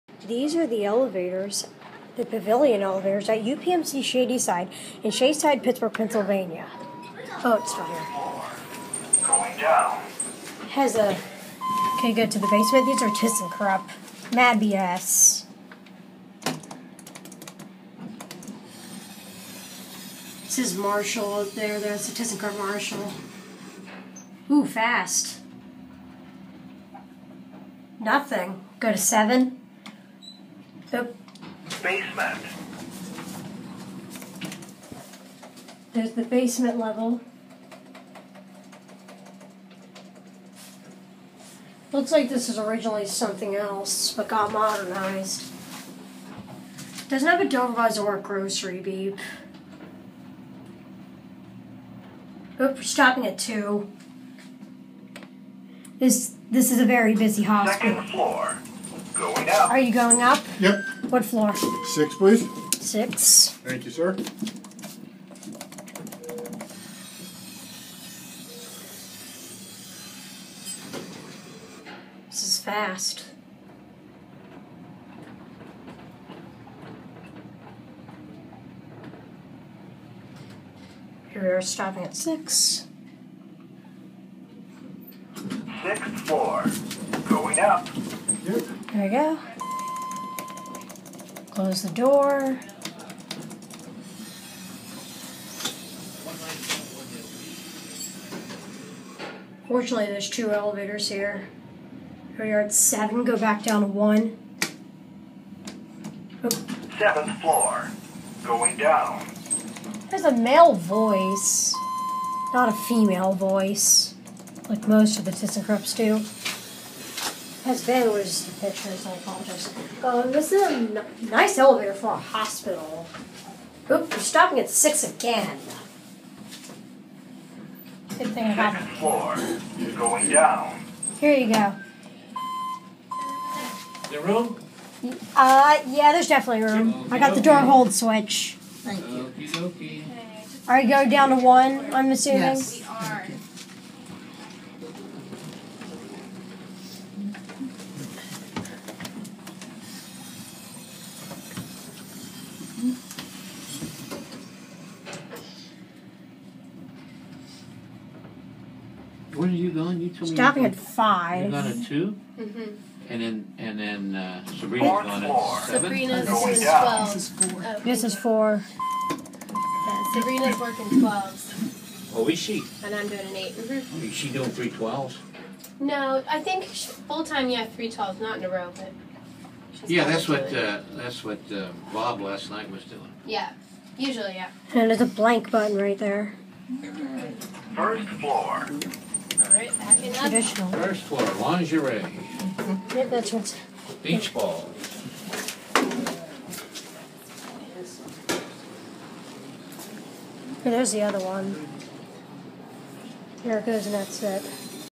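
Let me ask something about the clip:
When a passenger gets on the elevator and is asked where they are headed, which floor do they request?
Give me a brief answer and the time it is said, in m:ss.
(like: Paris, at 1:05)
6, at 1:01.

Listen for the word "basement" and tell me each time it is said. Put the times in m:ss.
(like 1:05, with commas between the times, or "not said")
0:12, 0:31, 0:36.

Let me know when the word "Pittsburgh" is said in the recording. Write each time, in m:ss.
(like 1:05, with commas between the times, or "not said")
0:05.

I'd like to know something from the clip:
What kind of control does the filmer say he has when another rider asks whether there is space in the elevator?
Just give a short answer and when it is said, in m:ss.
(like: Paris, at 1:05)
door hold switch, at 2:17.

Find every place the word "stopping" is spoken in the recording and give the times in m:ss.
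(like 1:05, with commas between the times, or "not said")
0:52, 1:21, 2:04, 2:40.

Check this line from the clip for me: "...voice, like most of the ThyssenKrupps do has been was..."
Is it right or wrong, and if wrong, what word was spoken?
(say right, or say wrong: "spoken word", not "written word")
right.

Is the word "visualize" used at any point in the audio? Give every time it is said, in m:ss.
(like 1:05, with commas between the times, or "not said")
not said.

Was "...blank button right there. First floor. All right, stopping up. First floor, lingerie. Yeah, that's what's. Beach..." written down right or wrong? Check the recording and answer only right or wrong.
wrong.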